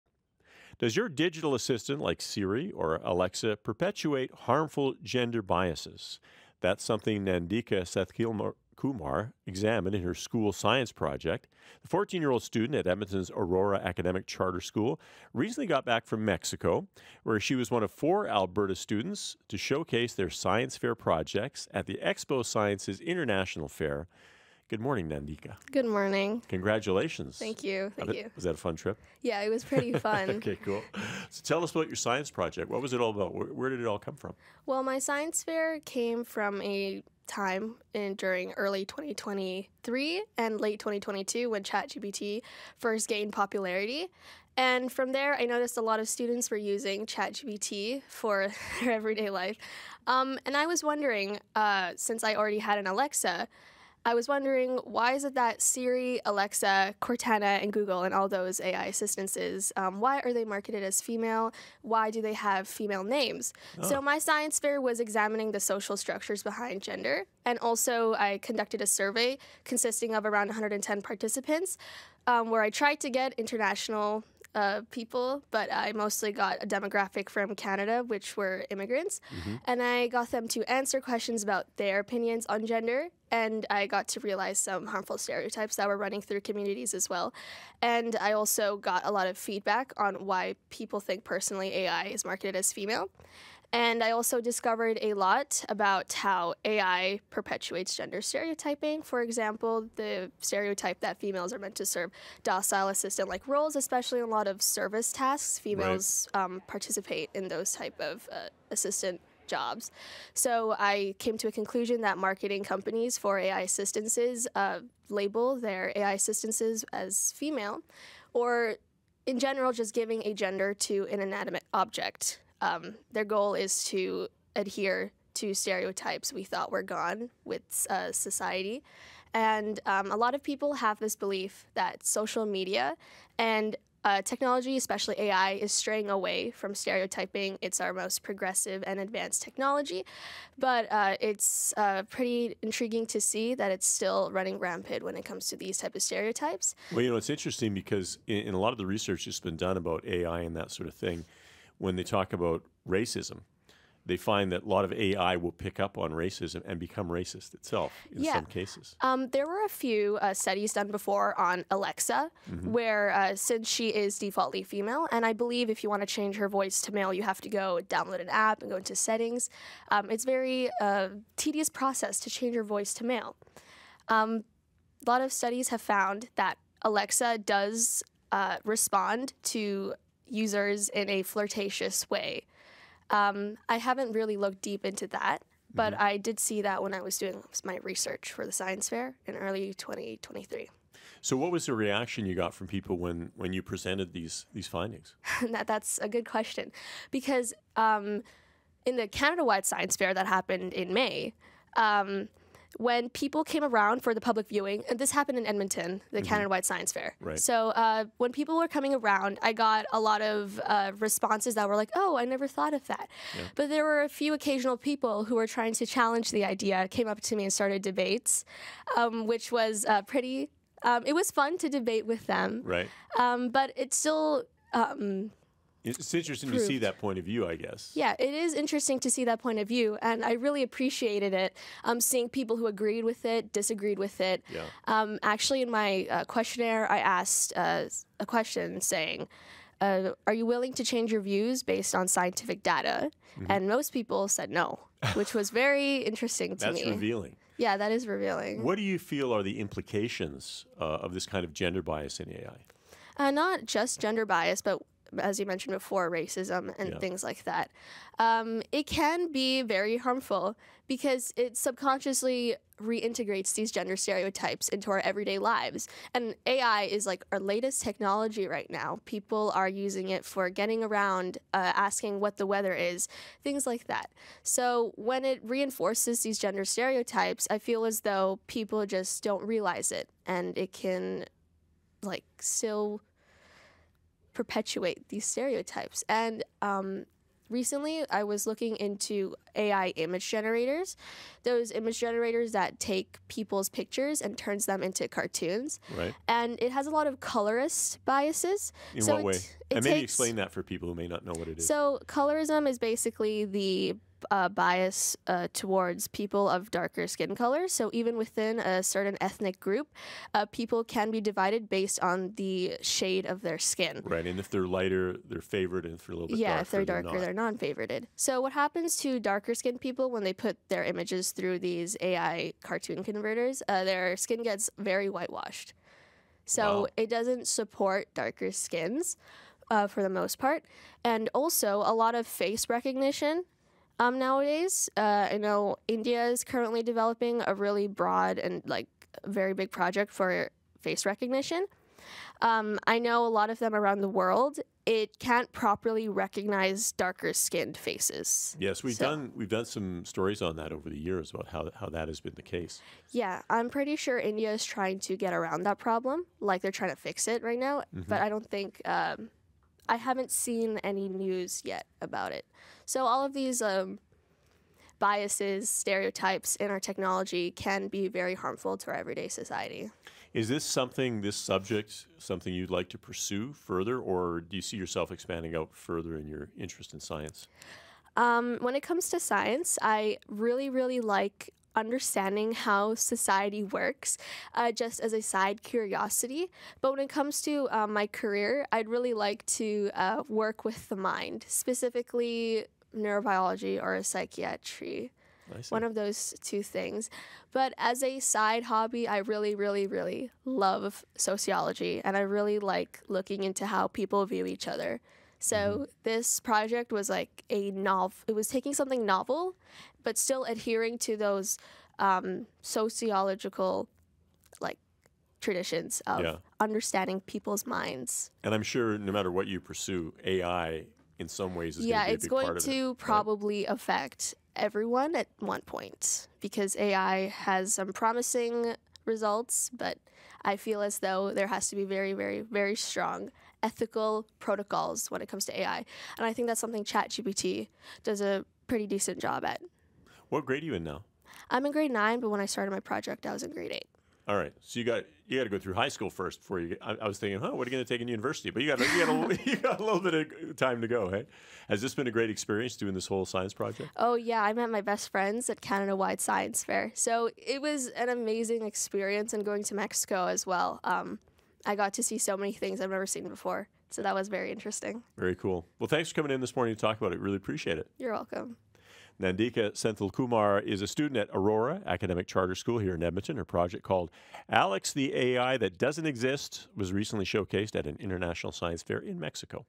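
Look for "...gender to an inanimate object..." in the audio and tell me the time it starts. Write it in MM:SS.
02:00.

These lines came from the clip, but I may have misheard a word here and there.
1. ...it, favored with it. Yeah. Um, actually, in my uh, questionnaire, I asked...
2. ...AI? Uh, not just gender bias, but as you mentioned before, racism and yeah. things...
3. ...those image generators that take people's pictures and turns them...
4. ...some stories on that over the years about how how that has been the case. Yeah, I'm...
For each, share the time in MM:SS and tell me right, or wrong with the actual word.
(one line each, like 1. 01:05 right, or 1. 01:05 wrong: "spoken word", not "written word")
1. 03:53 wrong: "disagreed", not "favored"
2. 04:12 right
3. 04:51 right
4. 05:49 right.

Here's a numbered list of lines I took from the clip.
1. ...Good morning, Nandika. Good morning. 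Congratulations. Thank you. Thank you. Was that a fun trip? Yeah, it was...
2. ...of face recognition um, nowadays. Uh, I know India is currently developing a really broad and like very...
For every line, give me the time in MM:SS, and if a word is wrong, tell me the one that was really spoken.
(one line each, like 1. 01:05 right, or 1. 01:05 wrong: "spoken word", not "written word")
1. 00:24 right
2. 05:32 right.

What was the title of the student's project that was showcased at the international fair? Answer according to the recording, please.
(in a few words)
Alex the AI That Doesn't Exist.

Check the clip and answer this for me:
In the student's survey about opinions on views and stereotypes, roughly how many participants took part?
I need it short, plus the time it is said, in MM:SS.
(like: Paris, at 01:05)
110, at 01:10.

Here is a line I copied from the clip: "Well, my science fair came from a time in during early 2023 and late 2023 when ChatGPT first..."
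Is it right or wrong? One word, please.
wrong.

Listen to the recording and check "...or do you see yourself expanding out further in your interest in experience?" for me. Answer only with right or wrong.
wrong.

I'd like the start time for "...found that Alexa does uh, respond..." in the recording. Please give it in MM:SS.
02:55.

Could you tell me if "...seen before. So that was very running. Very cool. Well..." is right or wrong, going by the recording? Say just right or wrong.
wrong.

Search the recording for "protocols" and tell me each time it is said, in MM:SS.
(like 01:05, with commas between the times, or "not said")
07:14.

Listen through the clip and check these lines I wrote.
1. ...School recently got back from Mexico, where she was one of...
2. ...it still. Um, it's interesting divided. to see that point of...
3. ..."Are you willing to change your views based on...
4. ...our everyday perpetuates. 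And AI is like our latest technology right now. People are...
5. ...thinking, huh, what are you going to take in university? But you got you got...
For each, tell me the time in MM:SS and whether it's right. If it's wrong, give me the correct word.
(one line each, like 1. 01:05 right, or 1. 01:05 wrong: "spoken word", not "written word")
1. 00:14 right
2. 03:43 wrong: "proved", not "divided"
3. 04:00 right
4. 04:24 wrong: "lives", not "perpetuates"
5. 07:27 right.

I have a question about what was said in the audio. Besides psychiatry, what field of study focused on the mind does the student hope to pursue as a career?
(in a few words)
Neurobiology.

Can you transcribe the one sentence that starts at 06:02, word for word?
So all of these um, biases, stereotypes in our technology can be very harmful to our everyday society.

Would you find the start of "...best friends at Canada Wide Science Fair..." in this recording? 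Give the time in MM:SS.
07:34.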